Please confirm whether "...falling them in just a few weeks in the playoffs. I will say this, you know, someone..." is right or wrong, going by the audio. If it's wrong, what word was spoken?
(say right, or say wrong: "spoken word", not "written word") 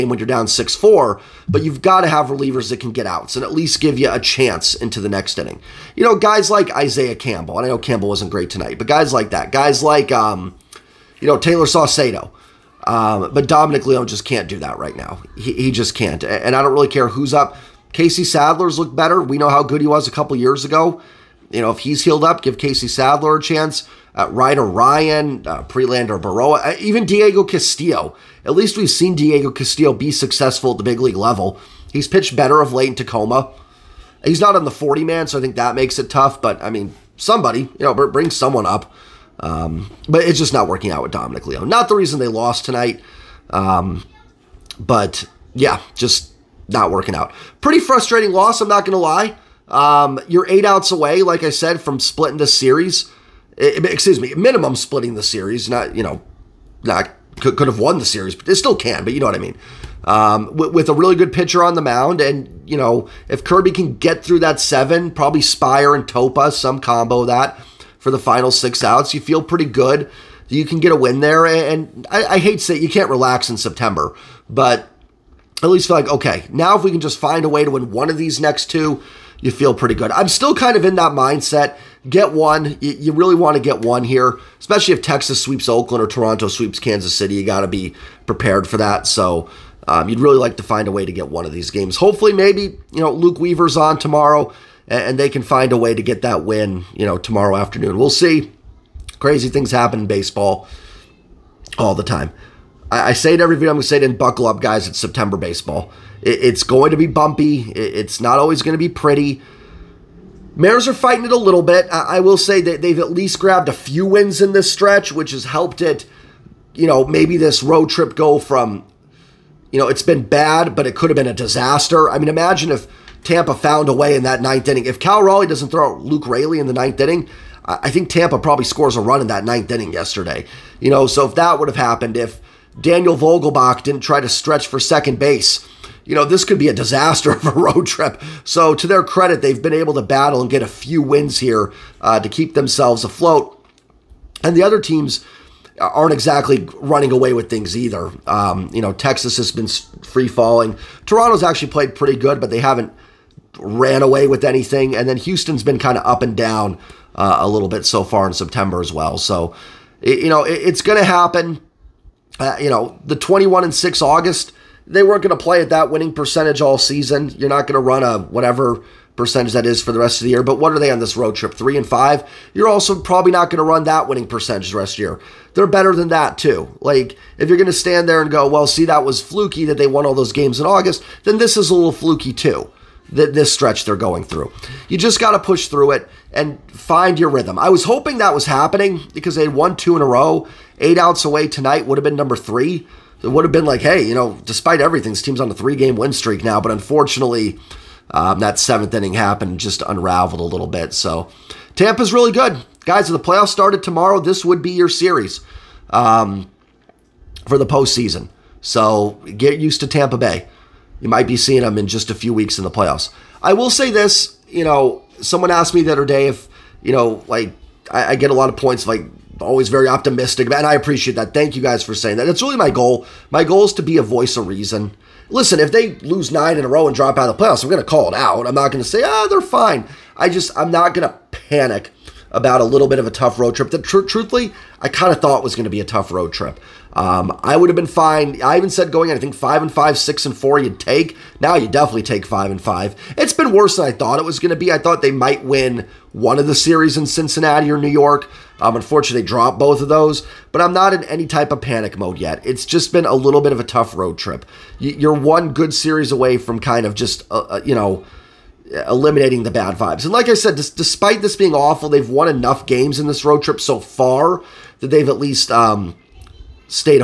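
wrong: "seeing", not "falling".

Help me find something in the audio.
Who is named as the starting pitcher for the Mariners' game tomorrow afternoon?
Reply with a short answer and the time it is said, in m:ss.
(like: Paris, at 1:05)
Luke Weaver, at 1:33.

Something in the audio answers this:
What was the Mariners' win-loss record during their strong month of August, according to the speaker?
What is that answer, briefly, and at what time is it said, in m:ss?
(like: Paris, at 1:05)
21 and 6, at 2:43.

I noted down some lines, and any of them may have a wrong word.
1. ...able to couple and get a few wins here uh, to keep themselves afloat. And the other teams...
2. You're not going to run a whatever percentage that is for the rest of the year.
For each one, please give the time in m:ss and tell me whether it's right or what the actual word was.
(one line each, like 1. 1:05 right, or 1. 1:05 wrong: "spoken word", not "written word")
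1. 2:19 wrong: "battle", not "couple"
2. 2:47 right.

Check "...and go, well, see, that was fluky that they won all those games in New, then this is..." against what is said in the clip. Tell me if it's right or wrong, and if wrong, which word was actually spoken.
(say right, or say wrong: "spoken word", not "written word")
wrong: "August", not "New".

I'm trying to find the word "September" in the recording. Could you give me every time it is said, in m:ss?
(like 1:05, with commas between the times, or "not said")
1:13, 1:44, 2:38.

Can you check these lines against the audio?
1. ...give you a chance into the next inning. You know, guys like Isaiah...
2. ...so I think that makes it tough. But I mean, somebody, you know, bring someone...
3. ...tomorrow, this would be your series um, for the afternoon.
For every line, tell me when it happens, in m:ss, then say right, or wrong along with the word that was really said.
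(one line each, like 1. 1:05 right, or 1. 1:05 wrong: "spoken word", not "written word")
1. 0:03 right
2. 0:35 right
3. 3:23 wrong: "postseason", not "afternoon".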